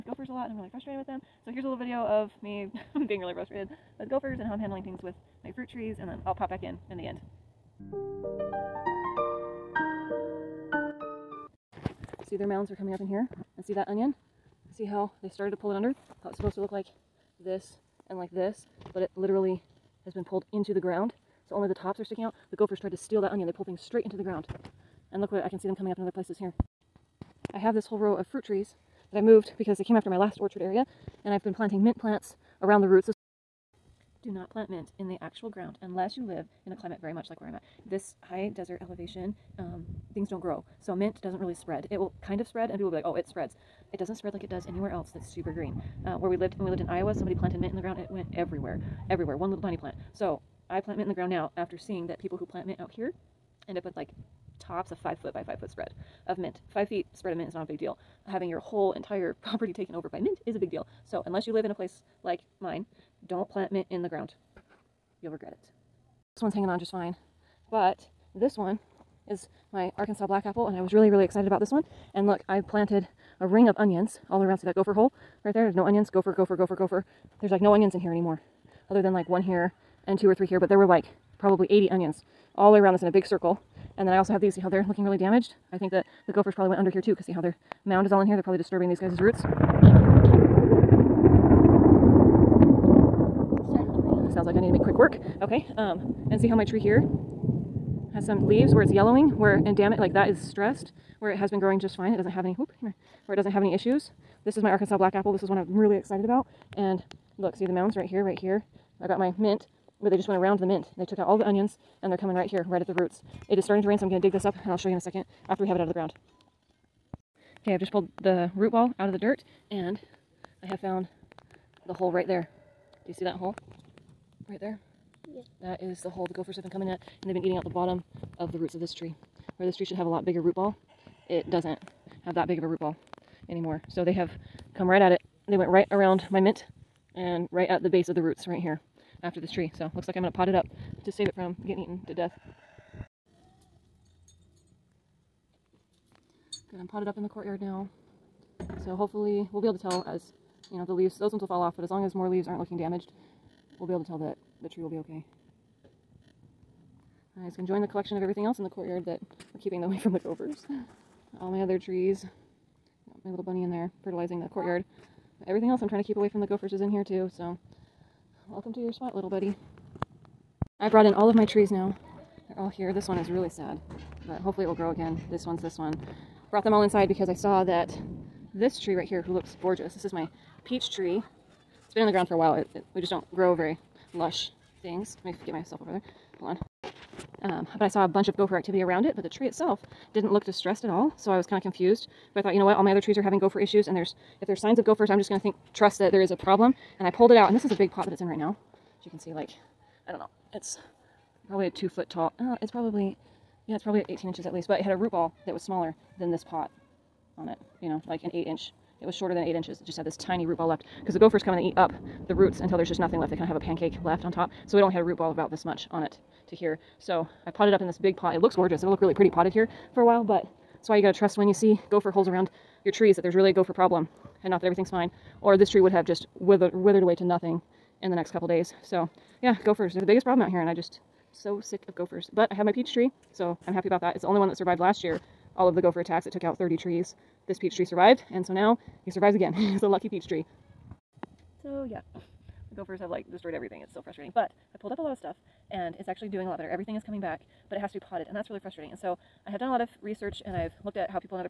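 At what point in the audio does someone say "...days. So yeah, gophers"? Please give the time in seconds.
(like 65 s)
228 s.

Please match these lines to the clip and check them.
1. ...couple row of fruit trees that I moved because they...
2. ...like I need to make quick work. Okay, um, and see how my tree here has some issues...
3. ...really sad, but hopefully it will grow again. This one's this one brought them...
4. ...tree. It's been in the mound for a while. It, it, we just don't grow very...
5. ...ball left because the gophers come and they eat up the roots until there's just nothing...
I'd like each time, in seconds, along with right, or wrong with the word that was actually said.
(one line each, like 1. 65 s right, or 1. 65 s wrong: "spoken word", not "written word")
1. 27 s wrong: "whole", not "couple"
2. 94 s wrong: "leaves", not "issues"
3. 173 s right
4. 180 s wrong: "ground", not "mound"
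5. 210 s right.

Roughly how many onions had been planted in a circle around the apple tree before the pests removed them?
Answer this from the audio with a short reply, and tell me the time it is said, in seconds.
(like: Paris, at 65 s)
80, at 81 s.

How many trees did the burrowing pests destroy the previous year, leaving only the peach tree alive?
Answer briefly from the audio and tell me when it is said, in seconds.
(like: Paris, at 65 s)
30, at 236 s.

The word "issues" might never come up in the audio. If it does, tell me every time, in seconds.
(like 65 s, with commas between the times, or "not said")
103 s, 193 s.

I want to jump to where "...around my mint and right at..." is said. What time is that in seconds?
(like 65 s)
135 s.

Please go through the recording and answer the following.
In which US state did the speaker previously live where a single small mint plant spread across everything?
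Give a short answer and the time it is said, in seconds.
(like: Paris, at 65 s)
Iowa, at 46 s.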